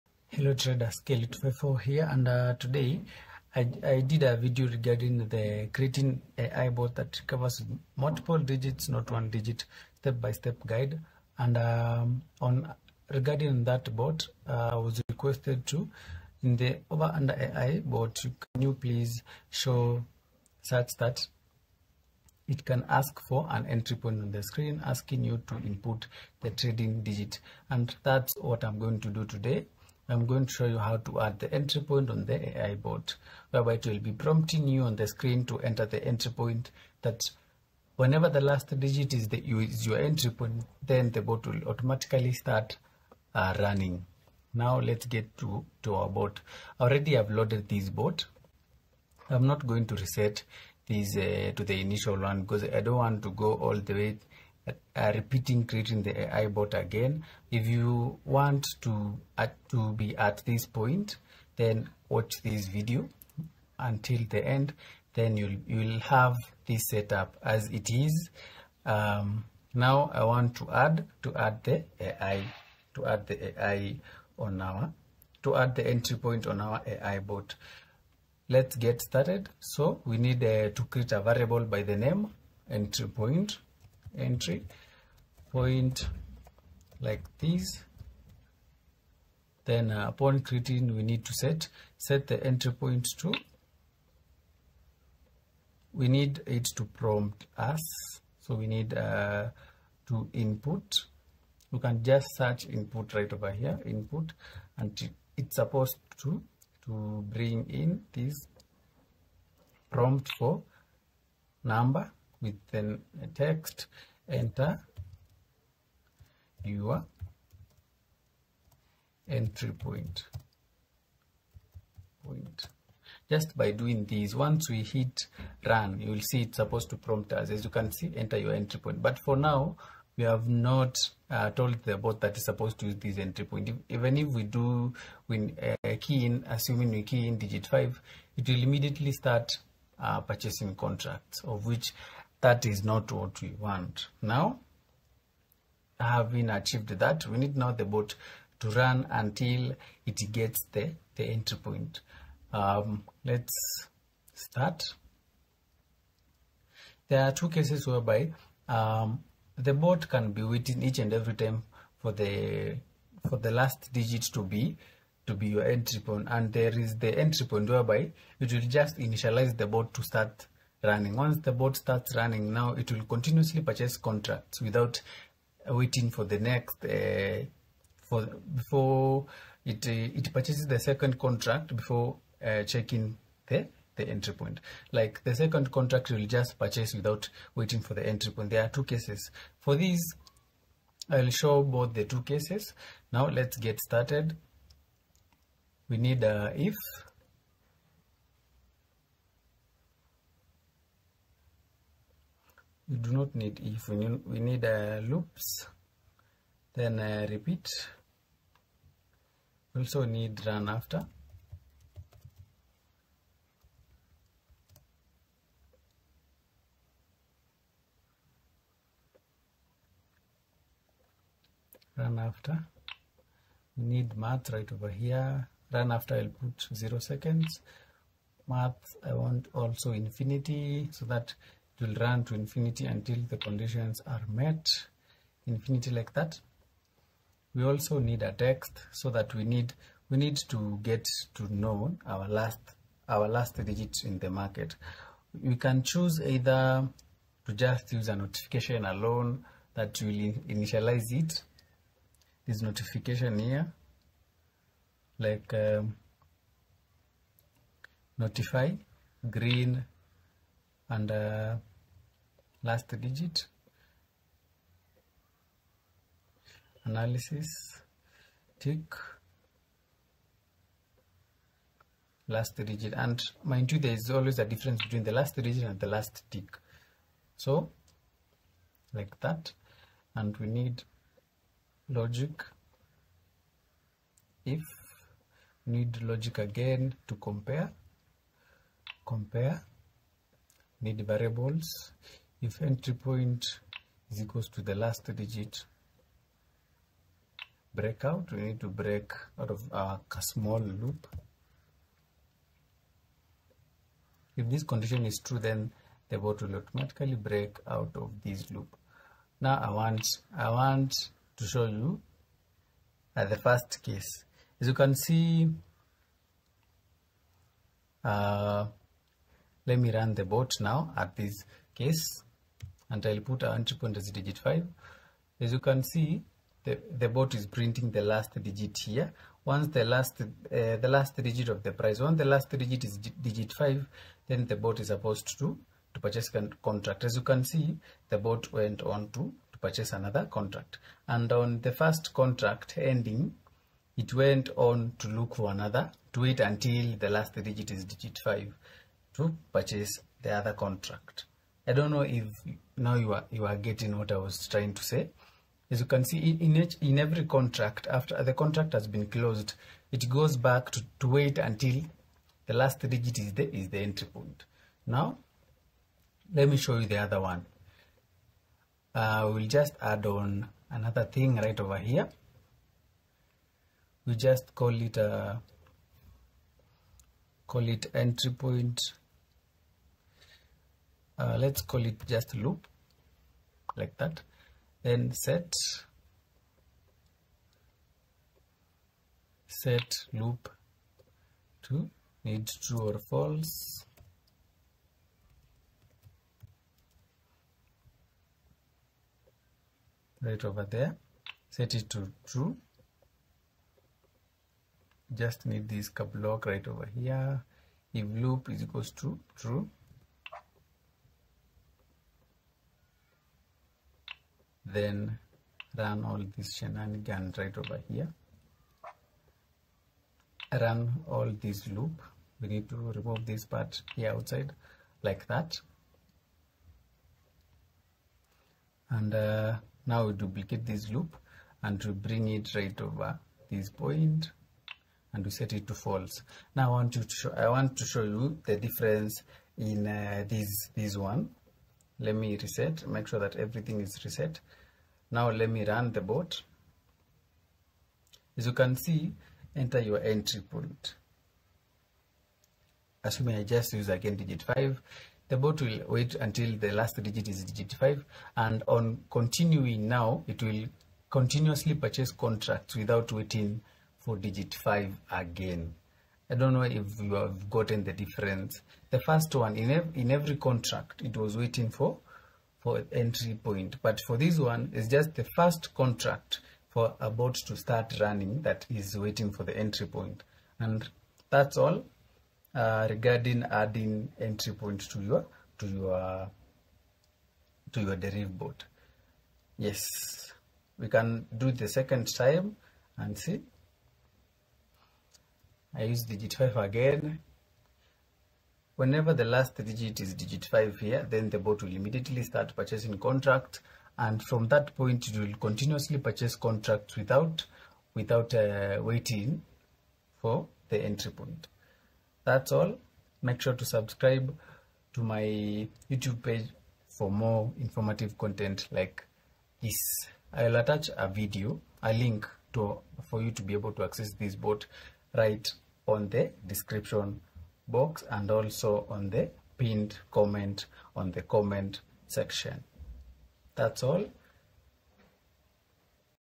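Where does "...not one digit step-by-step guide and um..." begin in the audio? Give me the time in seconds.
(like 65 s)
8 s.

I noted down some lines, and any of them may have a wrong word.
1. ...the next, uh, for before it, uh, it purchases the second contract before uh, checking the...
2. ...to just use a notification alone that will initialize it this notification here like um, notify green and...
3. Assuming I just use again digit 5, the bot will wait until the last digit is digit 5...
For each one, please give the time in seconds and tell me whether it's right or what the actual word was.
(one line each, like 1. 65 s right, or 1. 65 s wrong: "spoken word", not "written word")
1. 176 s right
2. 247 s right
3. 453 s right.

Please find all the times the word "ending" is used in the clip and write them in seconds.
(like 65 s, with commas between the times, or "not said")
342 s.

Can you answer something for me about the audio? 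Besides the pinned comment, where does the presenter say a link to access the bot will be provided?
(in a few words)
description box.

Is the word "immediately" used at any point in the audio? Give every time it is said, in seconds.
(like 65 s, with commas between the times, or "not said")
138 s, 501 s.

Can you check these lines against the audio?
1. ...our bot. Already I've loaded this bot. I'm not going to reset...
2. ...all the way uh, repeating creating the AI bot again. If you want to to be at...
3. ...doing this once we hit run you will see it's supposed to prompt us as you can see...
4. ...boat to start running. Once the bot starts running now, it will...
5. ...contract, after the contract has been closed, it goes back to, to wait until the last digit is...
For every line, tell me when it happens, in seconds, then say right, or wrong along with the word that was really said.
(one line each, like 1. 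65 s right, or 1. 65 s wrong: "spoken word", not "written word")
1. 45 s right
2. 53 s right
3. 123 s right
4. 169 s right
5. 357 s right.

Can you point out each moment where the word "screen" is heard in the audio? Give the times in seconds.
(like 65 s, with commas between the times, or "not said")
24 s, 35 s.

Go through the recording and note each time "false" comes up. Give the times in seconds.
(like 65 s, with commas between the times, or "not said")
393 s, 435 s.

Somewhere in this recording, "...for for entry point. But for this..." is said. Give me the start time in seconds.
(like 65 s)
471 s.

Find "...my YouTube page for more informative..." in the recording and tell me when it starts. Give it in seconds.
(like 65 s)
515 s.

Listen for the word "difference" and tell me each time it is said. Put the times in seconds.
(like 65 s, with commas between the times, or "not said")
274 s, 438 s, 467 s.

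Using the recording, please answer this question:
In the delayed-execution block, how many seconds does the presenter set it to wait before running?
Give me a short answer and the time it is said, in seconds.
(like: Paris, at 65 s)
0, at 226 s.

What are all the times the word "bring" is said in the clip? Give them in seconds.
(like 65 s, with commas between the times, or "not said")
107 s, 431 s.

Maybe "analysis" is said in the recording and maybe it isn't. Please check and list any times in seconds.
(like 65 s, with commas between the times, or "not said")
266 s.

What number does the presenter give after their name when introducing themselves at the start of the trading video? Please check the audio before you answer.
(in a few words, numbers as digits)
254.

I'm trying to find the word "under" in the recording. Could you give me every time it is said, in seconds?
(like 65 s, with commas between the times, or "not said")
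17 s.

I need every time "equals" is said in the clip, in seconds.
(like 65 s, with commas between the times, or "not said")
294 s, 408 s.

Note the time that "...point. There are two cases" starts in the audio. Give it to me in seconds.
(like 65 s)
188 s.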